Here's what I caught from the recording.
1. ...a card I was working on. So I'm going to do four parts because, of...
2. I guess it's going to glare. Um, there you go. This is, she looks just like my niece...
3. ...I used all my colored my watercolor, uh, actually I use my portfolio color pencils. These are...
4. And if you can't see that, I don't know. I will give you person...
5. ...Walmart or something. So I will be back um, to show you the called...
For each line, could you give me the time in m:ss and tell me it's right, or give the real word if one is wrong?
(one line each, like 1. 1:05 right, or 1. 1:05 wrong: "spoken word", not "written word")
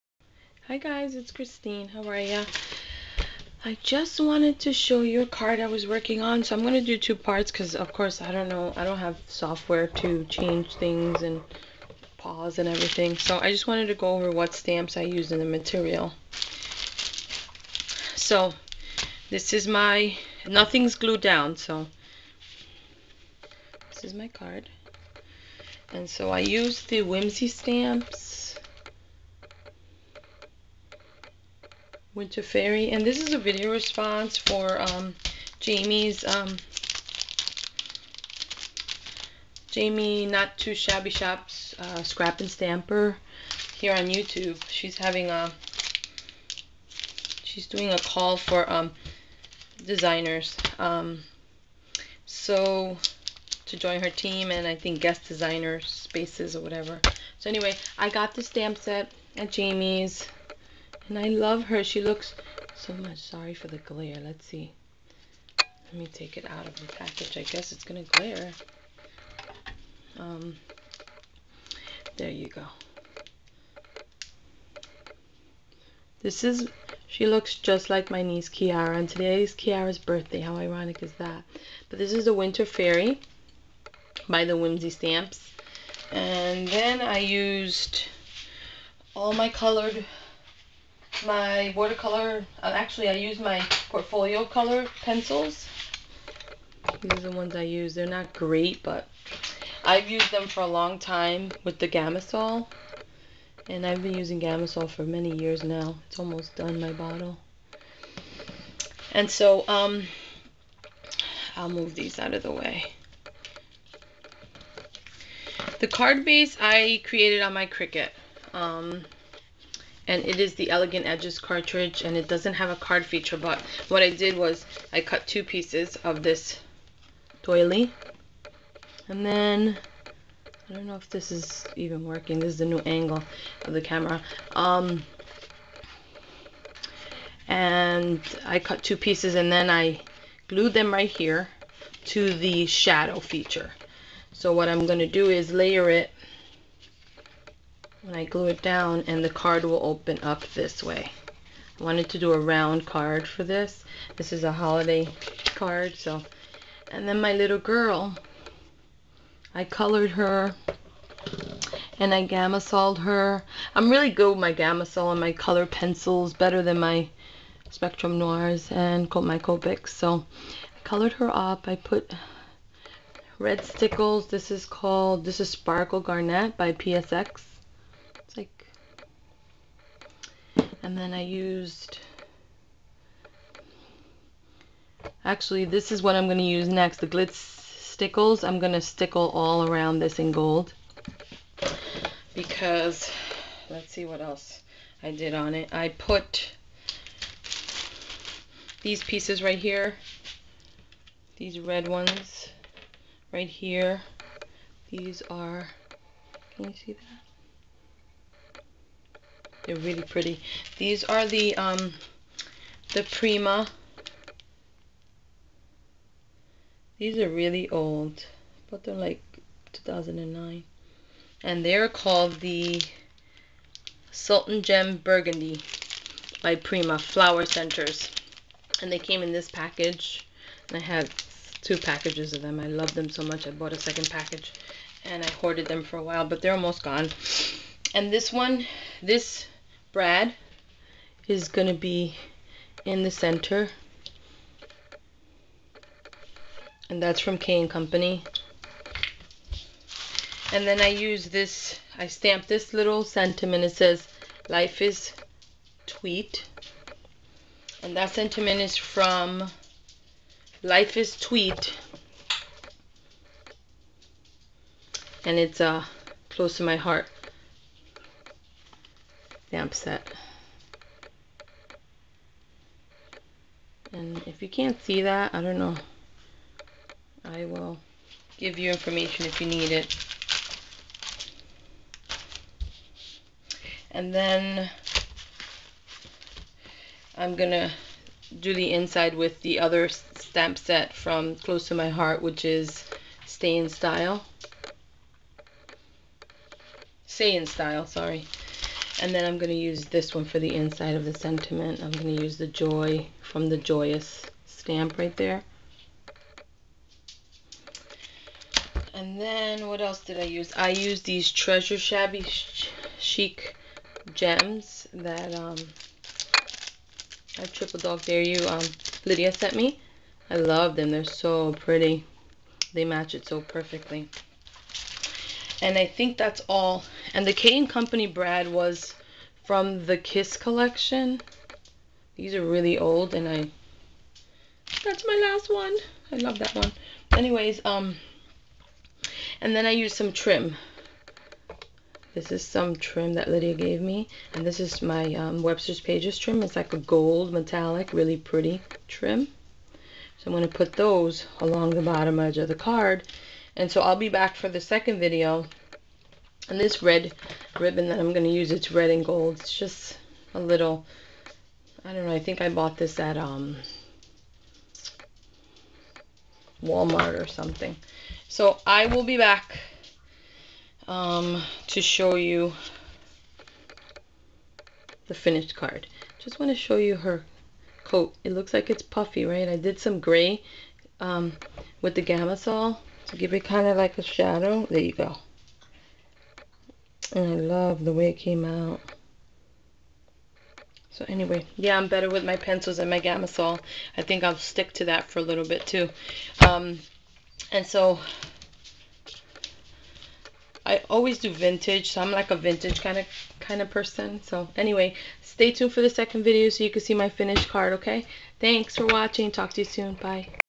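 1. 0:05 wrong: "two", not "four"
2. 1:07 right
3. 1:27 right
4. 4:33 wrong: "information", not "person"
5. 6:06 wrong: "finished", not "called".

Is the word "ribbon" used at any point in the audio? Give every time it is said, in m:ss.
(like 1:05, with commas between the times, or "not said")
5:57.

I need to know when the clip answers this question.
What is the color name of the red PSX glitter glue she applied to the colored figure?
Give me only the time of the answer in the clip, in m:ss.
2:55.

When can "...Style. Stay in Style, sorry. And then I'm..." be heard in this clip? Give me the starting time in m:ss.
4:53.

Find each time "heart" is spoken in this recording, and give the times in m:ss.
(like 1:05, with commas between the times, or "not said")
4:26, 4:51.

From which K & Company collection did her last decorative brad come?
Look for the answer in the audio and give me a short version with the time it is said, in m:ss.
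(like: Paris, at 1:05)
Kiss collection, at 5:29.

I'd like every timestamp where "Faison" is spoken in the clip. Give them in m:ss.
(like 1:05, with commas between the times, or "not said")
not said.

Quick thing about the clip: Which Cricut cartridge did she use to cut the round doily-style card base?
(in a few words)
Elegant Edges.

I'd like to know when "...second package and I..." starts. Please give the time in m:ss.
3:53.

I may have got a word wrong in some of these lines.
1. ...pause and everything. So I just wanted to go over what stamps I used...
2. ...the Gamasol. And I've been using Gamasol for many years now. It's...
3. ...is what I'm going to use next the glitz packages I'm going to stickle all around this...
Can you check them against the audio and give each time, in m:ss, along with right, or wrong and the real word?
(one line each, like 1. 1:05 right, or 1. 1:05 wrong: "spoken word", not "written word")
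1. 0:12 right
2. 1:41 right
3. 3:05 wrong: "stickles", not "packages".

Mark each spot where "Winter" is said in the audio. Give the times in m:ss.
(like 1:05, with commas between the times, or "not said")
0:32, 1:22.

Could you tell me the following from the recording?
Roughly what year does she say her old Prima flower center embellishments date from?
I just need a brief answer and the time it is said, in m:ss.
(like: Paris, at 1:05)
2009, at 3:39.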